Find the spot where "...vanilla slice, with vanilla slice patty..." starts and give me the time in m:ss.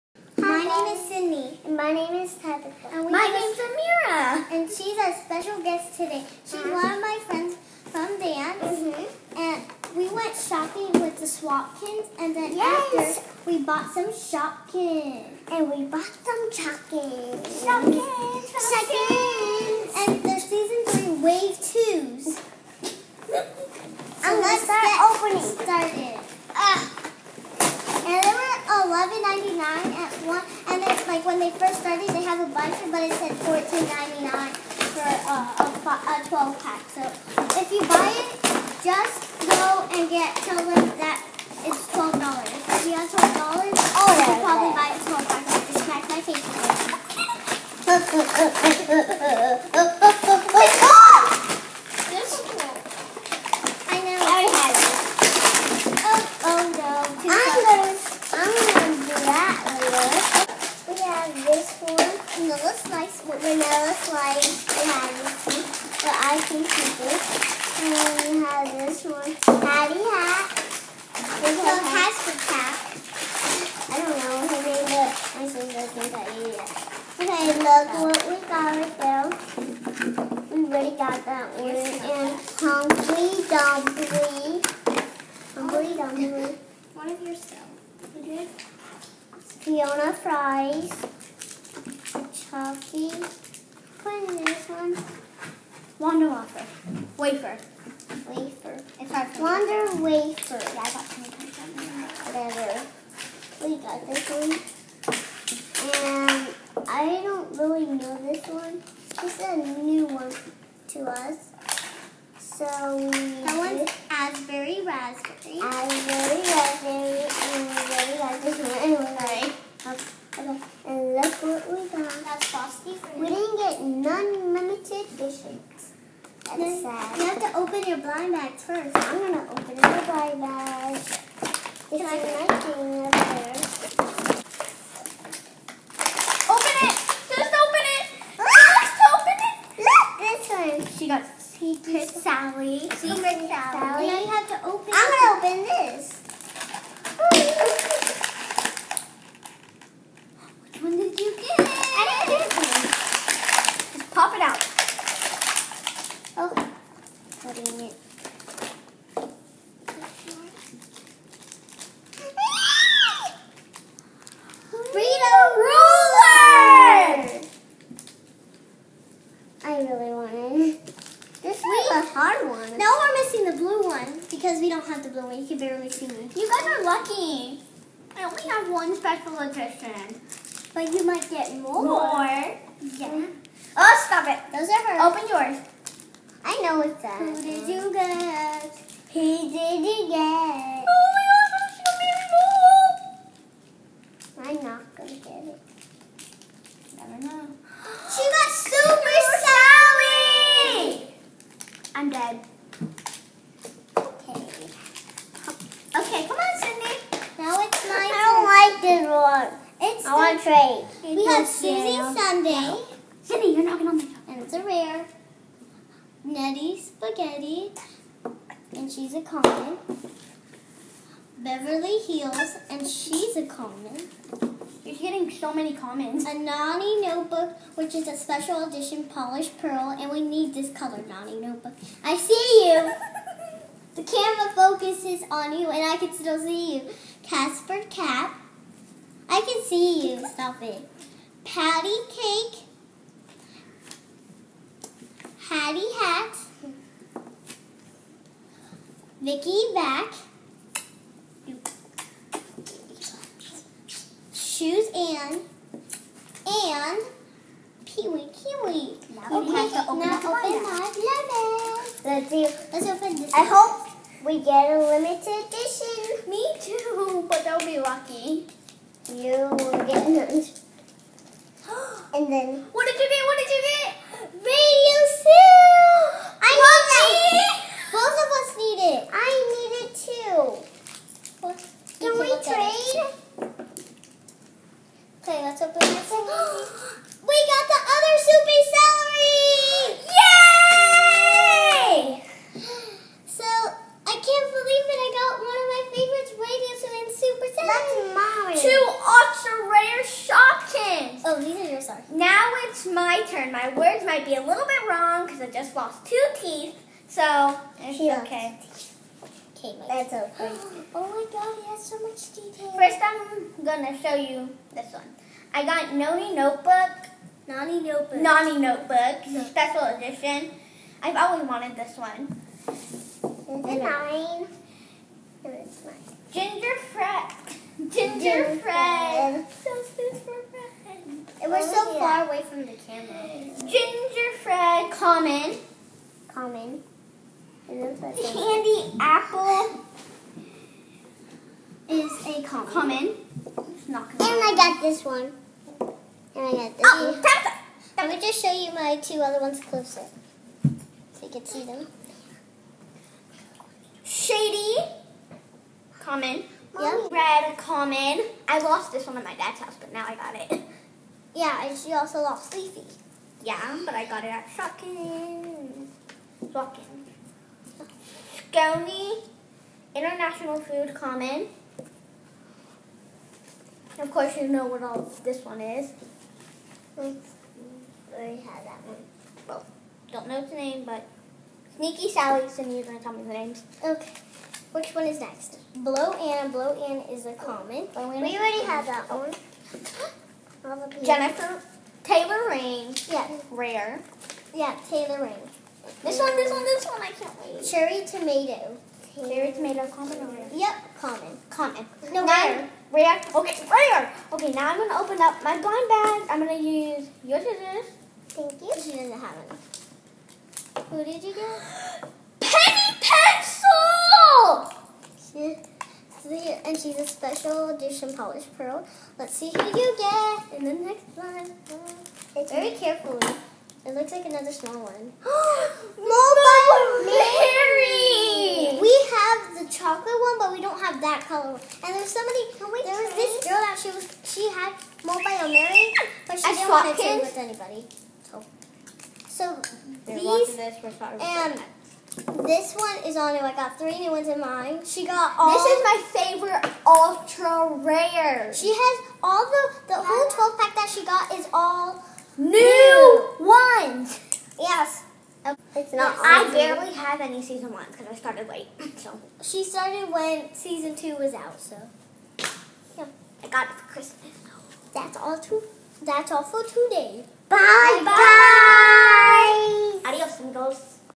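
1:02.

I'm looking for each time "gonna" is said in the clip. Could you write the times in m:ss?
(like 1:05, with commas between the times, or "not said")
5:13, 6:22.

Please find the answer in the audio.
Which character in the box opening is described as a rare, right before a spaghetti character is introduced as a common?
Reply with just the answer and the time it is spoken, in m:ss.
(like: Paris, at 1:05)
Suzie Sundae, at 3:31.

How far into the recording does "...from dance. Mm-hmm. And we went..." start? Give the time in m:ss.
0:07.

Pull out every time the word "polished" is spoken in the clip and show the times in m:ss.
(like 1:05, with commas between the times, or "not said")
3:49, 6:58.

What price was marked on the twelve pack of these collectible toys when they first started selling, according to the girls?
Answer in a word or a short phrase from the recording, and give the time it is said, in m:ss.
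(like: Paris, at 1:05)
$14.99, at 0:33.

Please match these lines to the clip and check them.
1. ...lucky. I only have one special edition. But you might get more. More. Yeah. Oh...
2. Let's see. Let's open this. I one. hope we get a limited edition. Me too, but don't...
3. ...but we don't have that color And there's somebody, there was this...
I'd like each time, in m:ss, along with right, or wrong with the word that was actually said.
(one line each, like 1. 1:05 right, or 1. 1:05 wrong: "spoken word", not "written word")
1. 2:56 right
2. 4:22 right
3. 7:10 right.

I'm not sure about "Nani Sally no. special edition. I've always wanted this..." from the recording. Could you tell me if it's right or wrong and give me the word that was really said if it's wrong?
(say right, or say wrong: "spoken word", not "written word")
wrong: "Notebook", not "Sally".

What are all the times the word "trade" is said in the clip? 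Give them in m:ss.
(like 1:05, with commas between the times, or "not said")
3:30, 7:17.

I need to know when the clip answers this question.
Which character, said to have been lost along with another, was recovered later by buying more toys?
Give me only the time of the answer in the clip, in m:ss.
6:02.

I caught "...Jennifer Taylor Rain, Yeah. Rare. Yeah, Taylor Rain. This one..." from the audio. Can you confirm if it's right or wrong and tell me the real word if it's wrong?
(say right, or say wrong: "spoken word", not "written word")
right.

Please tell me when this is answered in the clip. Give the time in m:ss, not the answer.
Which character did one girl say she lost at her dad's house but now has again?
5:54.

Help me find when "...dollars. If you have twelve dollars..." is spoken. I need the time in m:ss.
0:42.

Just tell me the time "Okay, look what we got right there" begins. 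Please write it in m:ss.
1:17.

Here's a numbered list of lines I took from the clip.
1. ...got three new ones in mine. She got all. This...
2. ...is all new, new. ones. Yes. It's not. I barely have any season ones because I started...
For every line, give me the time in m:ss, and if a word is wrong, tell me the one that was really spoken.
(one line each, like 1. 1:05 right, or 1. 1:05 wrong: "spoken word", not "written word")
1. 7:23 right
2. 7:31 right.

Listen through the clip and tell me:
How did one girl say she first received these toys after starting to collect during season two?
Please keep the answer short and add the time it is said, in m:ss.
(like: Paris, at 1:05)
For Christmas, at 7:43.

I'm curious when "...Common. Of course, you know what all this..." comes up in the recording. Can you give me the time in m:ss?
6:10.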